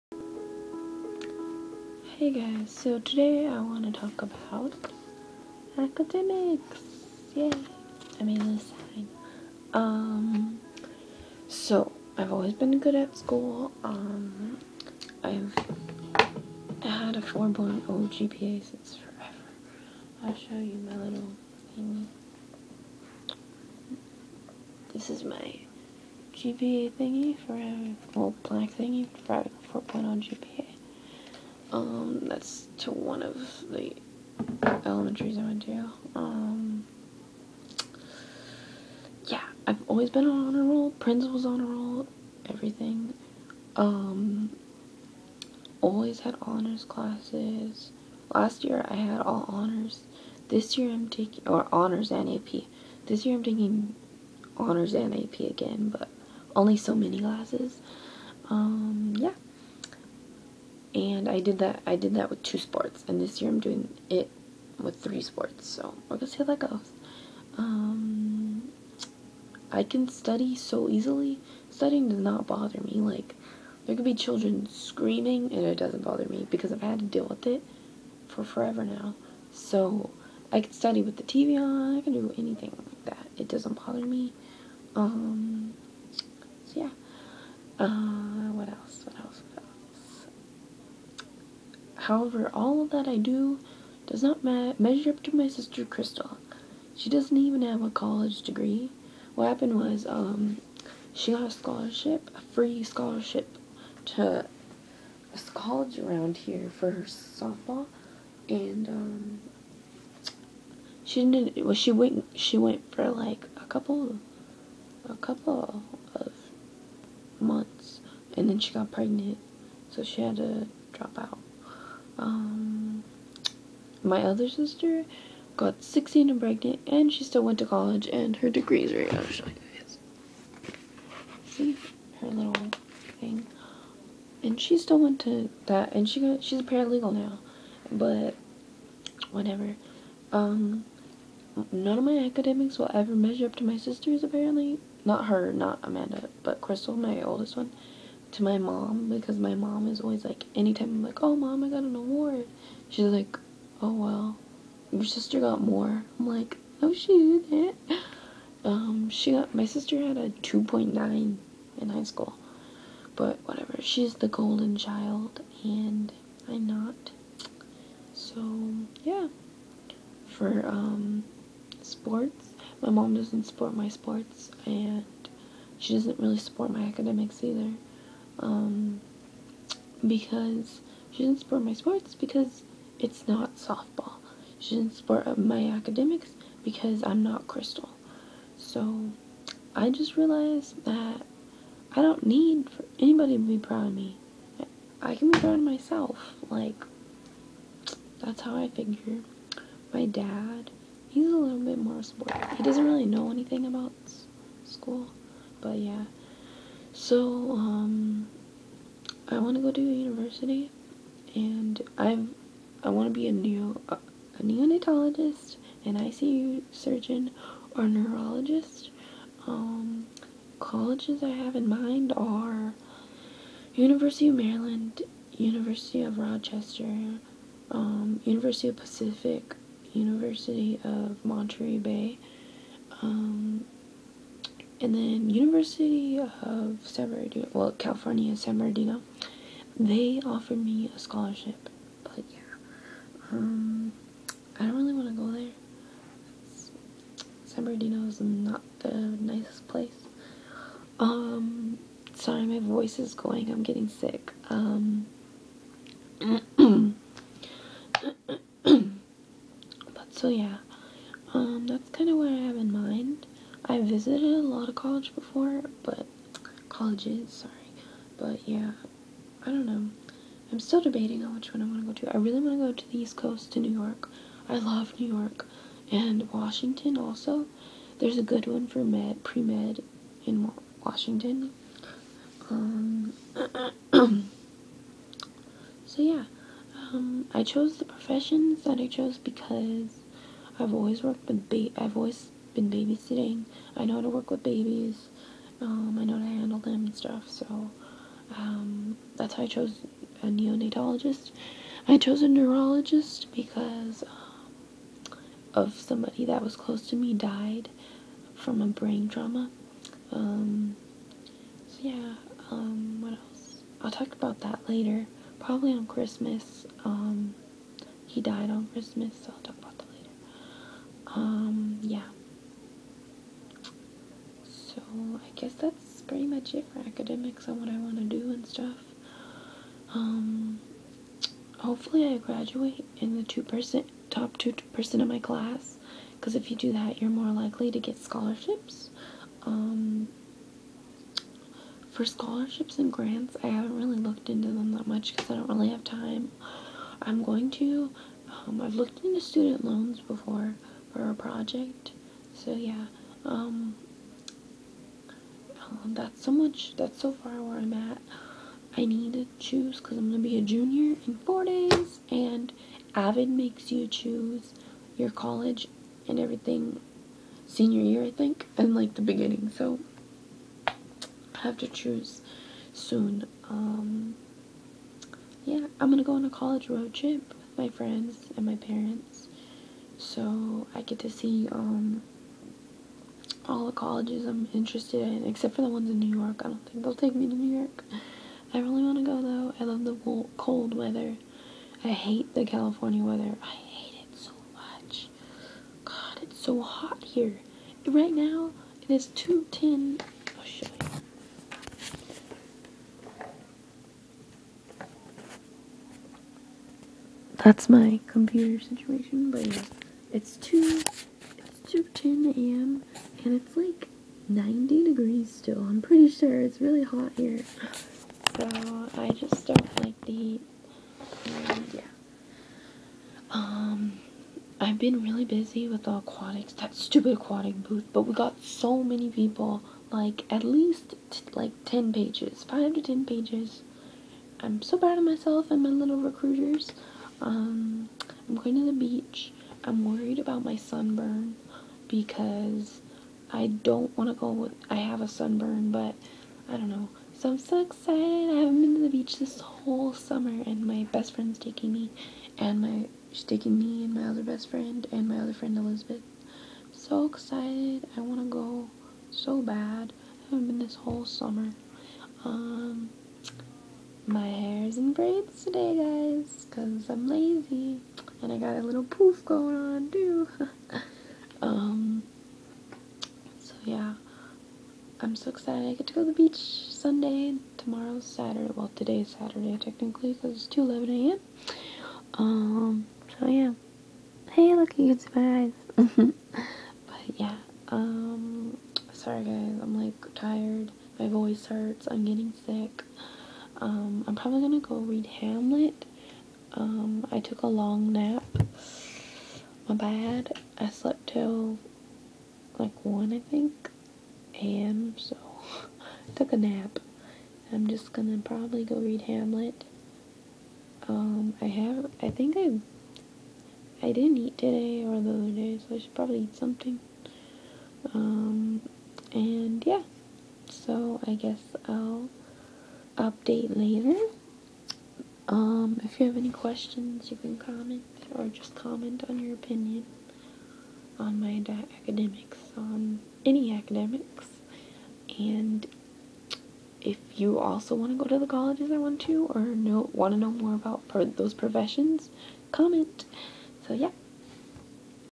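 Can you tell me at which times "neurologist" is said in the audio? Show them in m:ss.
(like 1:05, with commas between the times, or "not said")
3:37, 5:02.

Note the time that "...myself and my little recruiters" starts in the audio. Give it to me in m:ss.
7:15.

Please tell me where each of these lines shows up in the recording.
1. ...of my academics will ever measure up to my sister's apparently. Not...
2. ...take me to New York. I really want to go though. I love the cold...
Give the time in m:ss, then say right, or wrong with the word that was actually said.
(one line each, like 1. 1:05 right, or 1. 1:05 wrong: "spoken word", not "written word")
1. 2:21 right
2. 6:26 right.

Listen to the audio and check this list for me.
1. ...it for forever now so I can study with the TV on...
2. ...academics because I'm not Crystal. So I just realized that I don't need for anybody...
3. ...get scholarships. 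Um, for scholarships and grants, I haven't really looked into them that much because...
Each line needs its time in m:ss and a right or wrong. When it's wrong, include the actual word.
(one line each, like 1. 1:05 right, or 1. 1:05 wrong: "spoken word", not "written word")
1. 1:17 right
2. 3:05 right
3. 5:37 right.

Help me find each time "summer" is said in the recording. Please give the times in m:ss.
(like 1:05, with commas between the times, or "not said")
7:29, 7:41.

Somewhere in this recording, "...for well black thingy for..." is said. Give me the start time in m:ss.
0:27.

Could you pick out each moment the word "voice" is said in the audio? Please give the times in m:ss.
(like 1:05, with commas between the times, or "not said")
4:12, 8:11.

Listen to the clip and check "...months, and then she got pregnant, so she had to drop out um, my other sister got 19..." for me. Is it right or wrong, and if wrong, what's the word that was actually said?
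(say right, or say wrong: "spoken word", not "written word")
wrong: "16", not "19".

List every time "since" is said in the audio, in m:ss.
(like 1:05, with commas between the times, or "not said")
0:18.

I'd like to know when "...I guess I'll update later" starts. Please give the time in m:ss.
8:41.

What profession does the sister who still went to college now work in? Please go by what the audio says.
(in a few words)
Paralegal.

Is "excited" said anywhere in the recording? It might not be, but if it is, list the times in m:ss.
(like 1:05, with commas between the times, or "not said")
7:27, 7:37, 7:55.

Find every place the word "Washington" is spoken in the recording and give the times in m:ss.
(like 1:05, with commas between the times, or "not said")
4:36, 4:40.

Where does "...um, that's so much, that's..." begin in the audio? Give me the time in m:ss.
5:53.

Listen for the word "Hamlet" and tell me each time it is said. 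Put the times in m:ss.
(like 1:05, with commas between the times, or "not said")
8:15, 8:29.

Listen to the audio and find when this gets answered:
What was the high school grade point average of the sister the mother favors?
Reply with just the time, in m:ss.
2:40.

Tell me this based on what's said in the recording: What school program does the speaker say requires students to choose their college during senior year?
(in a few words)
Avid.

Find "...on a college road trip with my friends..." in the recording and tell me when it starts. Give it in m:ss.
6:16.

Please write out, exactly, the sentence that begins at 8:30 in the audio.
Um, I have, I think I, I didn't eat today or the other day, so I should probably eat something.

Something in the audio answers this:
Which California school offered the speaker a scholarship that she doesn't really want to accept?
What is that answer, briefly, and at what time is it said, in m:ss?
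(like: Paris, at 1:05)
California, San Bernardino, at 3:57.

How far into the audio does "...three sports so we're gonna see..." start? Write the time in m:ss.
1:04.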